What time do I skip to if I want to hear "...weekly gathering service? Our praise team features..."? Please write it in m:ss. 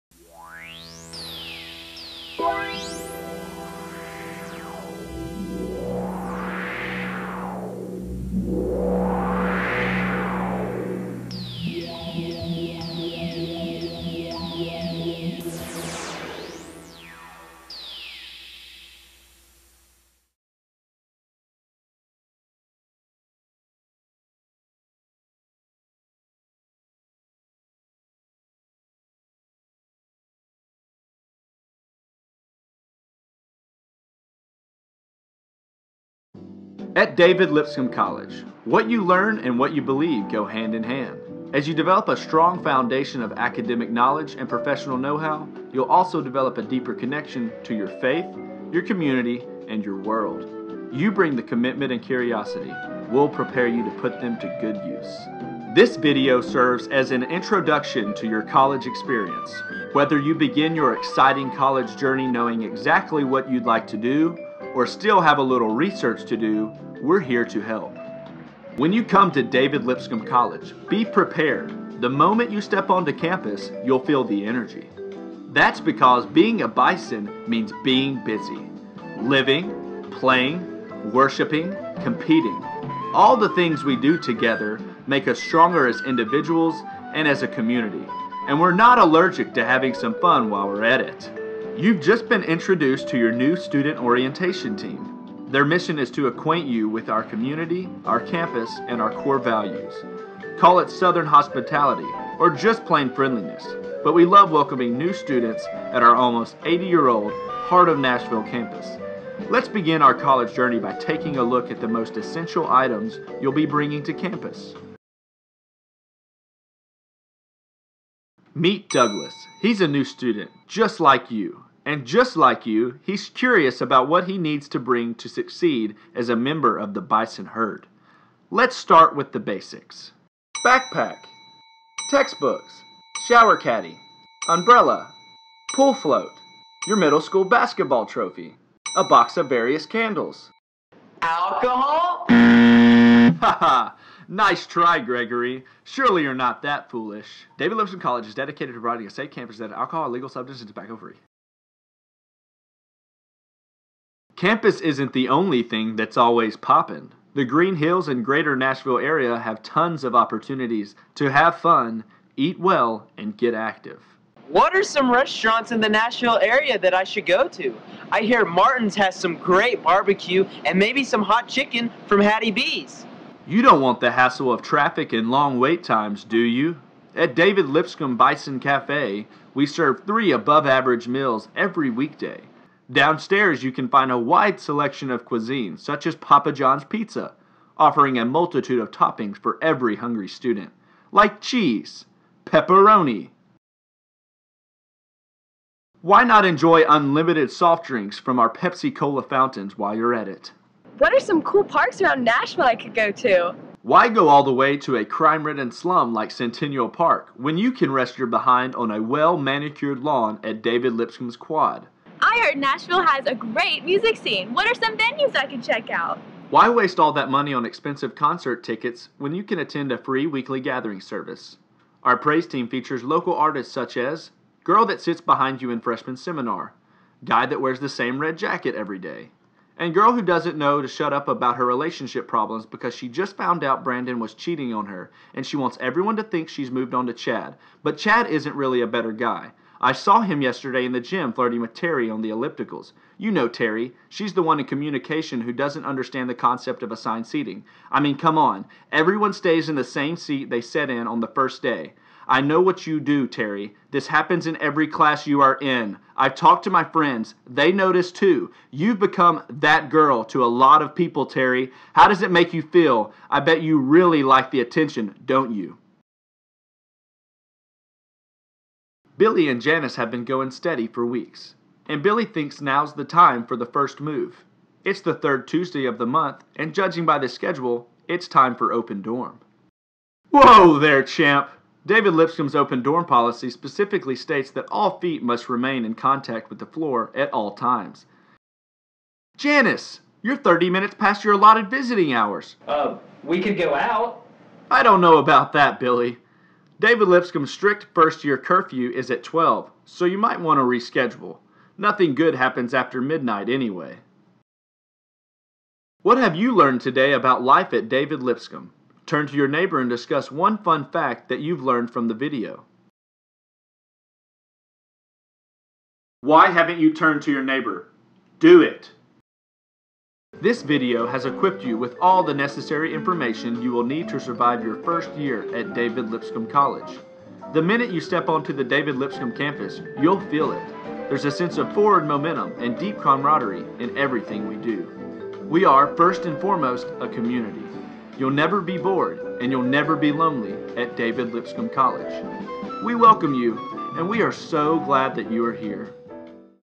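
3:40.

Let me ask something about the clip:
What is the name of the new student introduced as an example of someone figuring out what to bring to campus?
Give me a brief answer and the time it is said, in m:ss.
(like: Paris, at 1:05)
Douglas, at 1:58.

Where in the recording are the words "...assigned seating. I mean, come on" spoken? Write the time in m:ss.
4:06.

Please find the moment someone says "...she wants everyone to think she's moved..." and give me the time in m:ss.
3:55.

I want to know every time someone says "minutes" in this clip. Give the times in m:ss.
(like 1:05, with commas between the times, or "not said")
4:50, 5:27.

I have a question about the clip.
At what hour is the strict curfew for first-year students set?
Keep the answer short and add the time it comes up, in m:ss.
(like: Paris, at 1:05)
12, at 4:59.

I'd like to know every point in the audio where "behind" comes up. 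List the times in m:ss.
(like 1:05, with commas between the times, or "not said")
3:28, 3:45.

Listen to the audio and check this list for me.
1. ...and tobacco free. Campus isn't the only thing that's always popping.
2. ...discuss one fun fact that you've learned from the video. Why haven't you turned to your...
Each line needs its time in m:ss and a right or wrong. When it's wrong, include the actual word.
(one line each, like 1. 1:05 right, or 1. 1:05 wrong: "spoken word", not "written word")
1. 2:30 right
2. 5:09 right.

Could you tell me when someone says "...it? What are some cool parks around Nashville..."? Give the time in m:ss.
3:20.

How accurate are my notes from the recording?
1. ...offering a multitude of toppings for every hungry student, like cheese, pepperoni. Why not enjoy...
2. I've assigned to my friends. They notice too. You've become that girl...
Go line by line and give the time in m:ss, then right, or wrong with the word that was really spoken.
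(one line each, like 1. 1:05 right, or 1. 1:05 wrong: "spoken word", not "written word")
1. 3:07 right
2. 4:16 wrong: "talked", not "assigned".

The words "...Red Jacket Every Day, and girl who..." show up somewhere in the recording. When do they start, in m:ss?
3:48.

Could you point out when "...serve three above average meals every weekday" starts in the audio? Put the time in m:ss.
2:59.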